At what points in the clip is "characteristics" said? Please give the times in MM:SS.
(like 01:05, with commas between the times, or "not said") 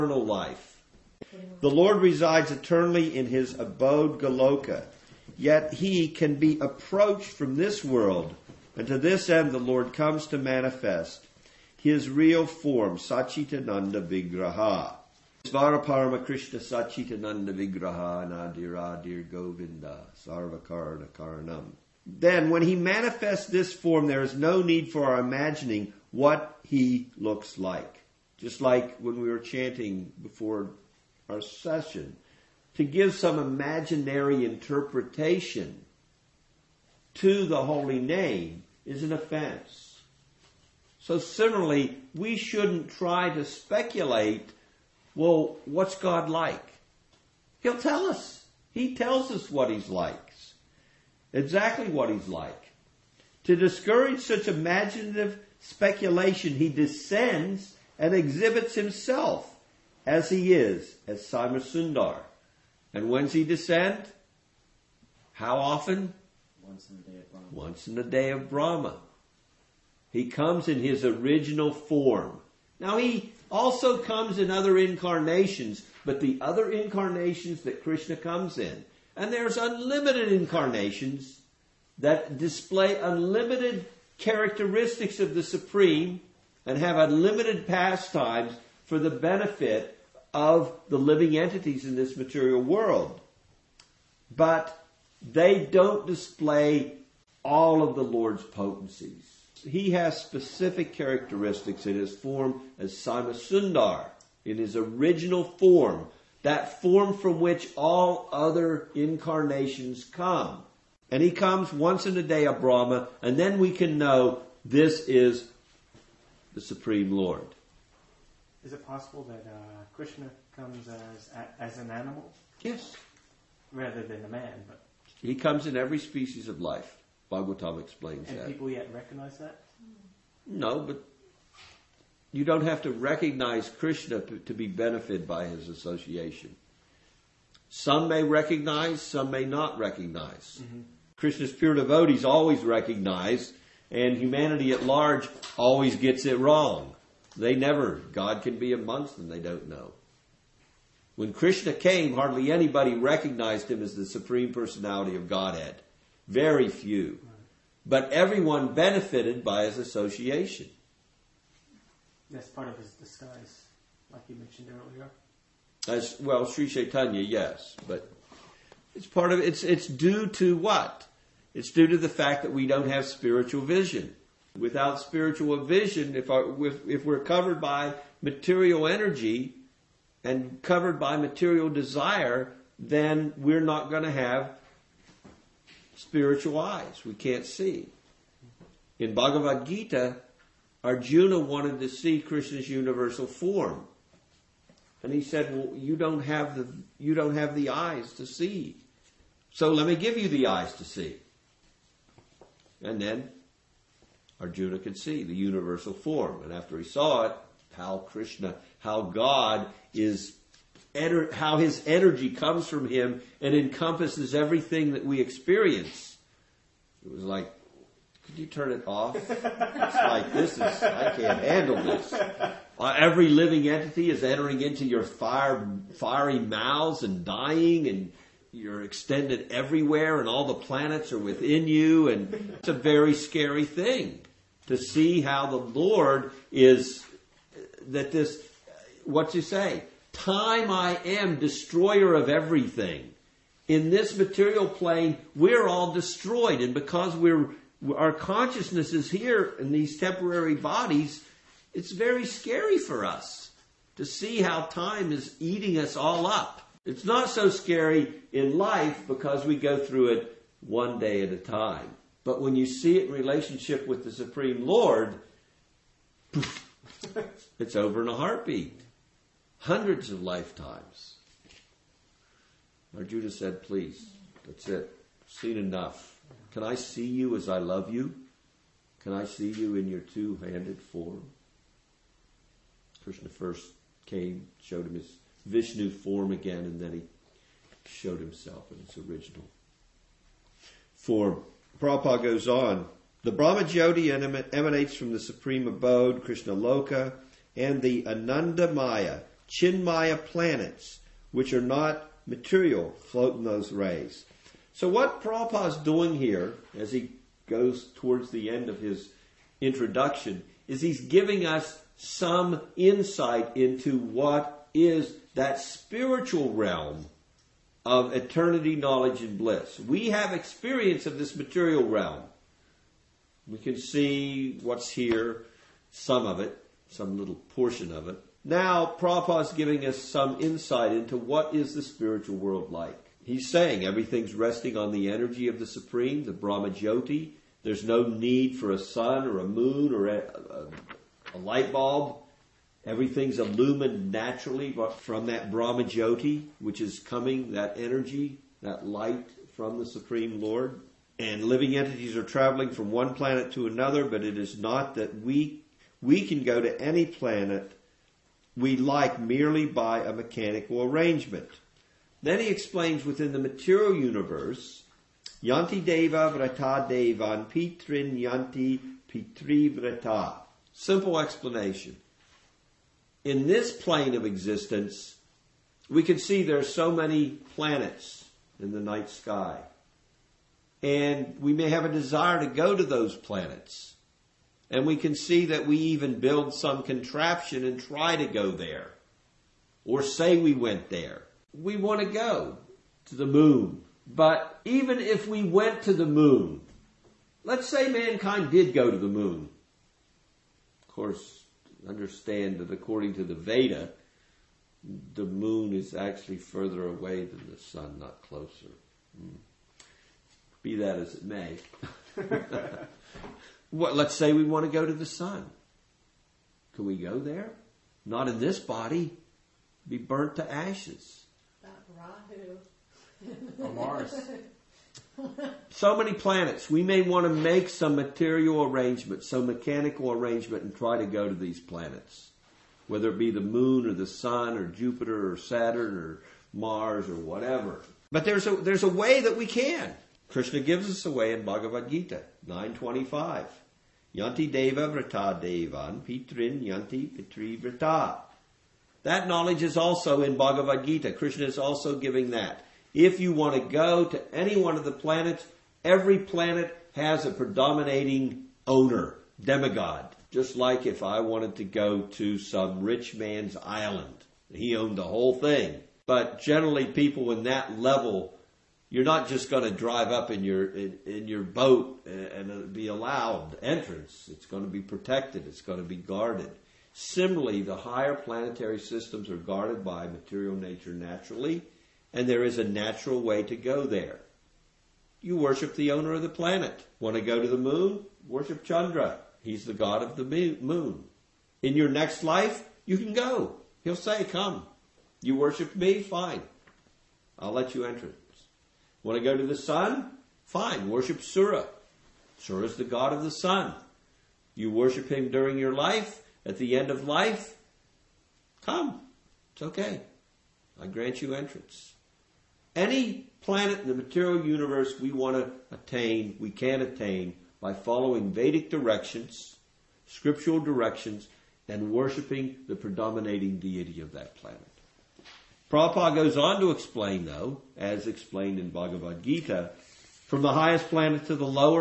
01:24, 01:40.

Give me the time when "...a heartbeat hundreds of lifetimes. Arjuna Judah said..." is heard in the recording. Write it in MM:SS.
04:28.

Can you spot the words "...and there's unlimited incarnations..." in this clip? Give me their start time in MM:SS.
01:19.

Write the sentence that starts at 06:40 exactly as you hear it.
Of course, understand that according to the Veda, the moon is actually further away than the sun, not closer.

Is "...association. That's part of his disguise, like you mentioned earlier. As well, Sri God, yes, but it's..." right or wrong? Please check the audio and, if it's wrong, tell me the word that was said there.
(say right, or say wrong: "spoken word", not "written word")
wrong: "Chaitanya", not "God".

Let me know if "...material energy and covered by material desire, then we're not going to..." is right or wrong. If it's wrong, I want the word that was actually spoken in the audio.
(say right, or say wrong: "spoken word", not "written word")
right.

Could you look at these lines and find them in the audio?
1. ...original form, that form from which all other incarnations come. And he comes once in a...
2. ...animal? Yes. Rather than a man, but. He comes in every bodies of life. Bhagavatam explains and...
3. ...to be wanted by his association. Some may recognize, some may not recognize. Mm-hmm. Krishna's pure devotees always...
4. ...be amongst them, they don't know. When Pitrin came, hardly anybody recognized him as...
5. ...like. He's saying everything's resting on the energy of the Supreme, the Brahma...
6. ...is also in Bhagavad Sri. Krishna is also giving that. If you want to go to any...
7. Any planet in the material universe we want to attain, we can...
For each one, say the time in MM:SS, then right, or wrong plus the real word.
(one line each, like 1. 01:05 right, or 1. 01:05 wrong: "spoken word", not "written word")
1. 01:44 right
2. 02:01 wrong: "species", not "bodies"
3. 02:14 wrong: "benefited", not "wanted"
4. 02:28 wrong: "Krishna", not "Pitrin"
5. 05:32 right
6. 07:29 wrong: "Gita", not "Sri"
7. 08:32 right.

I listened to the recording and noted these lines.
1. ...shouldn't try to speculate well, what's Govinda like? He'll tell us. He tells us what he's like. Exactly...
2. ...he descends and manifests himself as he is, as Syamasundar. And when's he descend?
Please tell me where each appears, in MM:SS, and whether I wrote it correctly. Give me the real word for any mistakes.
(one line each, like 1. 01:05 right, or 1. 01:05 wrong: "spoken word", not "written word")
1. 00:42 wrong: "God", not "Govinda"
2. 00:56 wrong: "exhibits", not "manifests".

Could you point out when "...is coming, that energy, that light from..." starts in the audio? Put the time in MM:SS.
05:46.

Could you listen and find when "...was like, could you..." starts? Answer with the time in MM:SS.
03:37.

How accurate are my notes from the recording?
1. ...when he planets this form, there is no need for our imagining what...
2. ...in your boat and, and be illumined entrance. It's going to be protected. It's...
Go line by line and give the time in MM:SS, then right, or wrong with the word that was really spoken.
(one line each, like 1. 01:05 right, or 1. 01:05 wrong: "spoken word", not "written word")
1. 00:22 wrong: "manifests", not "planets"
2. 07:51 wrong: "allowed", not "illumined".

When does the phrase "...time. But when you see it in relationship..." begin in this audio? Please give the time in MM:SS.
04:21.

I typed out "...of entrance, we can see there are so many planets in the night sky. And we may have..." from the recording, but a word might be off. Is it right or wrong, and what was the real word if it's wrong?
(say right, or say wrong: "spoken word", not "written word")
wrong: "existence", not "entrance".